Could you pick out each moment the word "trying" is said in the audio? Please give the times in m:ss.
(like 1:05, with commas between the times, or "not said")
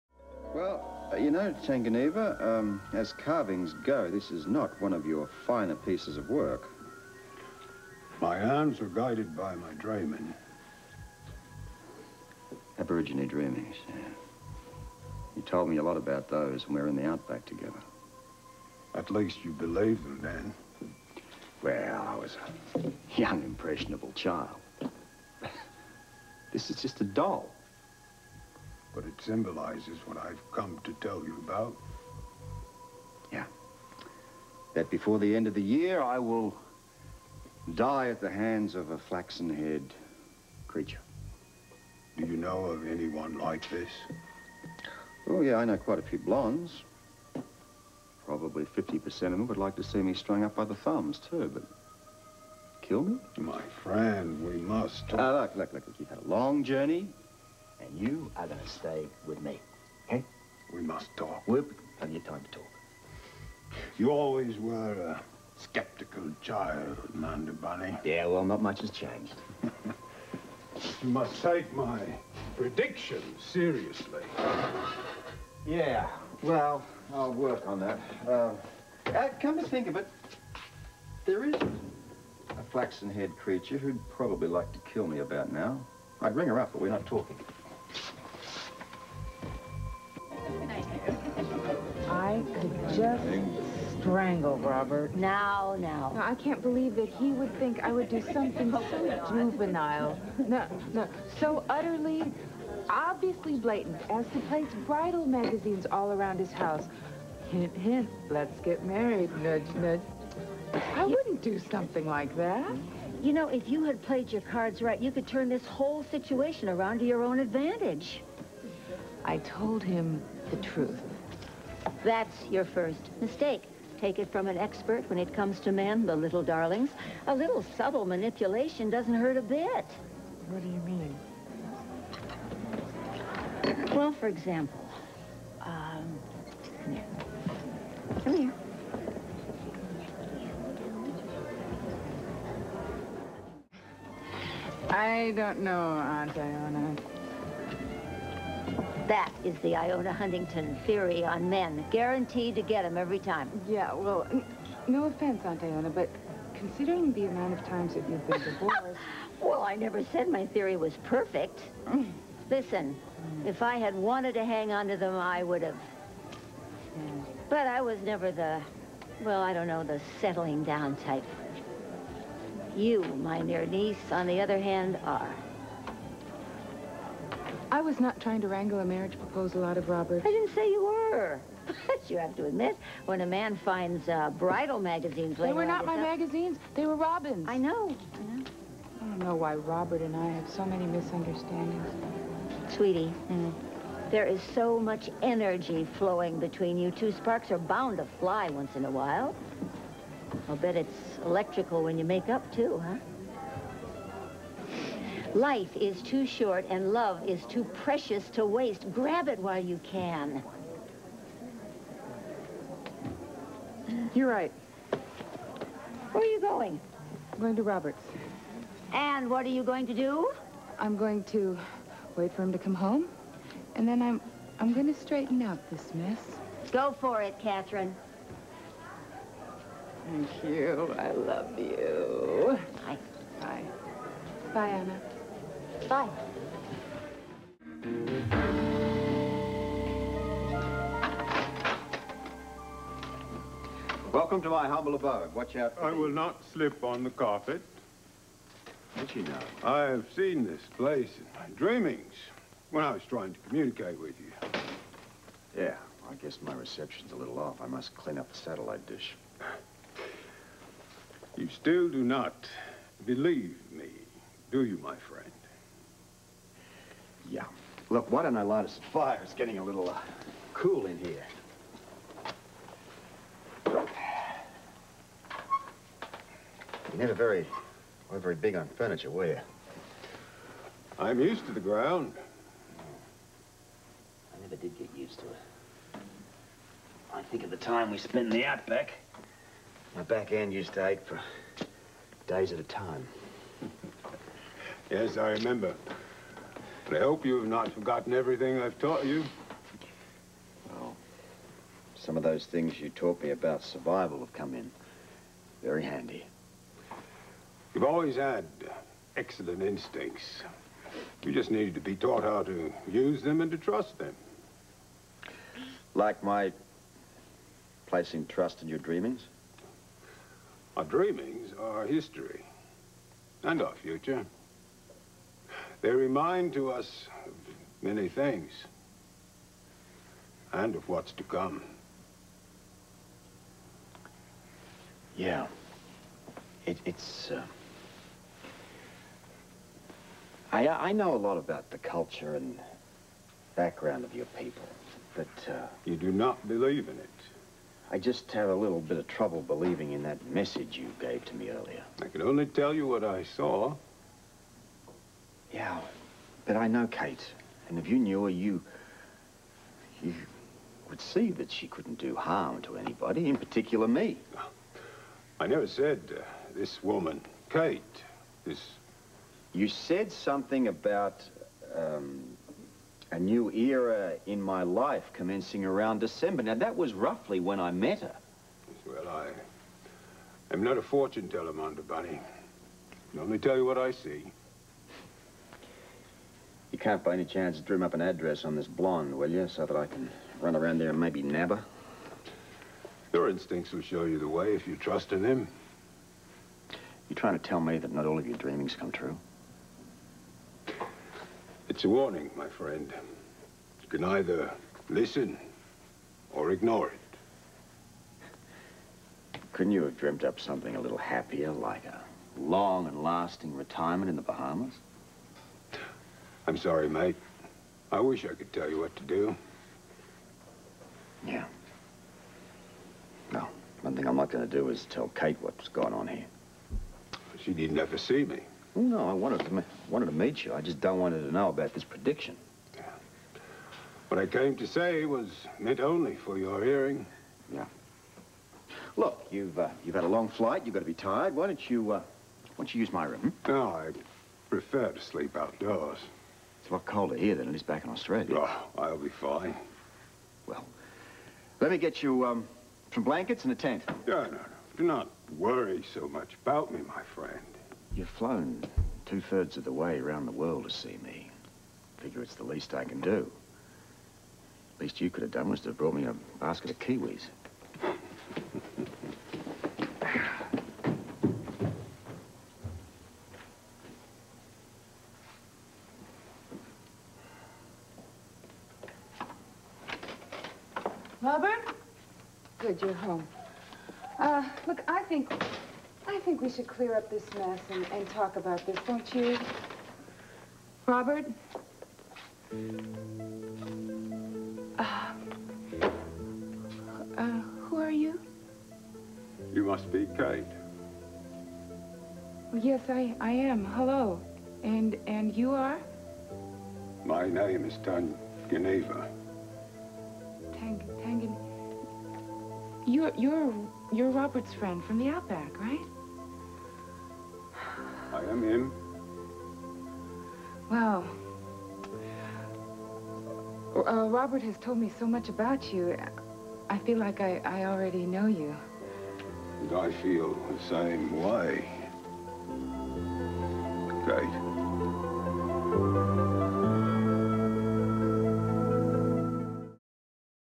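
2:58, 4:13, 6:37.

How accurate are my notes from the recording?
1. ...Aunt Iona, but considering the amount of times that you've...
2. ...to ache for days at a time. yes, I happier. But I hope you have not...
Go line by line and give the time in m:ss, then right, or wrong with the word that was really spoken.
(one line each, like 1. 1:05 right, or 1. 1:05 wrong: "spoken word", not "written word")
1. 2:35 right
2. 4:50 wrong: "remember", not "happier".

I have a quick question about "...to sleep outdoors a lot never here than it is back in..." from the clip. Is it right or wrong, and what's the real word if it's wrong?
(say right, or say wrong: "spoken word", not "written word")
wrong: "colder", not "never".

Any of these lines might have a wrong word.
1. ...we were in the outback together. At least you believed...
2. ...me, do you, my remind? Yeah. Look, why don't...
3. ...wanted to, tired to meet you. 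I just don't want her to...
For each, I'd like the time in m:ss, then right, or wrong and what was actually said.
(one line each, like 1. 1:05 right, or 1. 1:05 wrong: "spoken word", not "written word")
1. 0:16 right
2. 4:23 wrong: "friend", not "remind"
3. 7:09 wrong: "wanted", not "tired".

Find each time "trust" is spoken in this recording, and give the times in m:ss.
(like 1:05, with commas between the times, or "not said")
5:13, 5:18, 6:34.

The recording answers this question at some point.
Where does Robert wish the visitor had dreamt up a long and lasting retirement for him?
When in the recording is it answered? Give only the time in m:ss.
6:54.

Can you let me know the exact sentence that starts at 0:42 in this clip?
Do you know of anyone like this?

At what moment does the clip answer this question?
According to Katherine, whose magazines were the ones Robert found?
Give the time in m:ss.
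3:06.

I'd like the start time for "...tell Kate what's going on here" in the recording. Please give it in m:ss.
7:04.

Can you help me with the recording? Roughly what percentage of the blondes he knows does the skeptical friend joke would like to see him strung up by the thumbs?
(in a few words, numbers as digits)
50%.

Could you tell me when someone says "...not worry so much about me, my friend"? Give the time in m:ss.
7:34.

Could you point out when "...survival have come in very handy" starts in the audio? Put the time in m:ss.
5:03.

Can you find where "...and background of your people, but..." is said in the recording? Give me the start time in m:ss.
5:42.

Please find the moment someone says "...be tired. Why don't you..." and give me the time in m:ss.
7:20.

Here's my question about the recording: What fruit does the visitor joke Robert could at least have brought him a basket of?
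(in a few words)
Kiwis.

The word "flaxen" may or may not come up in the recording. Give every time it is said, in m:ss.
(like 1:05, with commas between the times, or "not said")
0:38, 1:22.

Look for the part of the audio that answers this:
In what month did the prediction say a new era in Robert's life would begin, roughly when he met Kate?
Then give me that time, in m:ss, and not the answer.
6:15.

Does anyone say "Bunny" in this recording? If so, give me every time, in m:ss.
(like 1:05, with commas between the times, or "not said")
1:07, 6:21.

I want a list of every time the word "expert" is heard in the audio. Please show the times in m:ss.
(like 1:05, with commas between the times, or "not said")
2:04.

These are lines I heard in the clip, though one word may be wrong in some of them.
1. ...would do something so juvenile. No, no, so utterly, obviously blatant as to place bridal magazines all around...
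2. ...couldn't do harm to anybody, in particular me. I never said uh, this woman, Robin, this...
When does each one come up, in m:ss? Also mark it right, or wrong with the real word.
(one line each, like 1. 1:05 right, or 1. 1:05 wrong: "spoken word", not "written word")
1. 1:37 right
2. 6:01 wrong: "Kate", not "Robin".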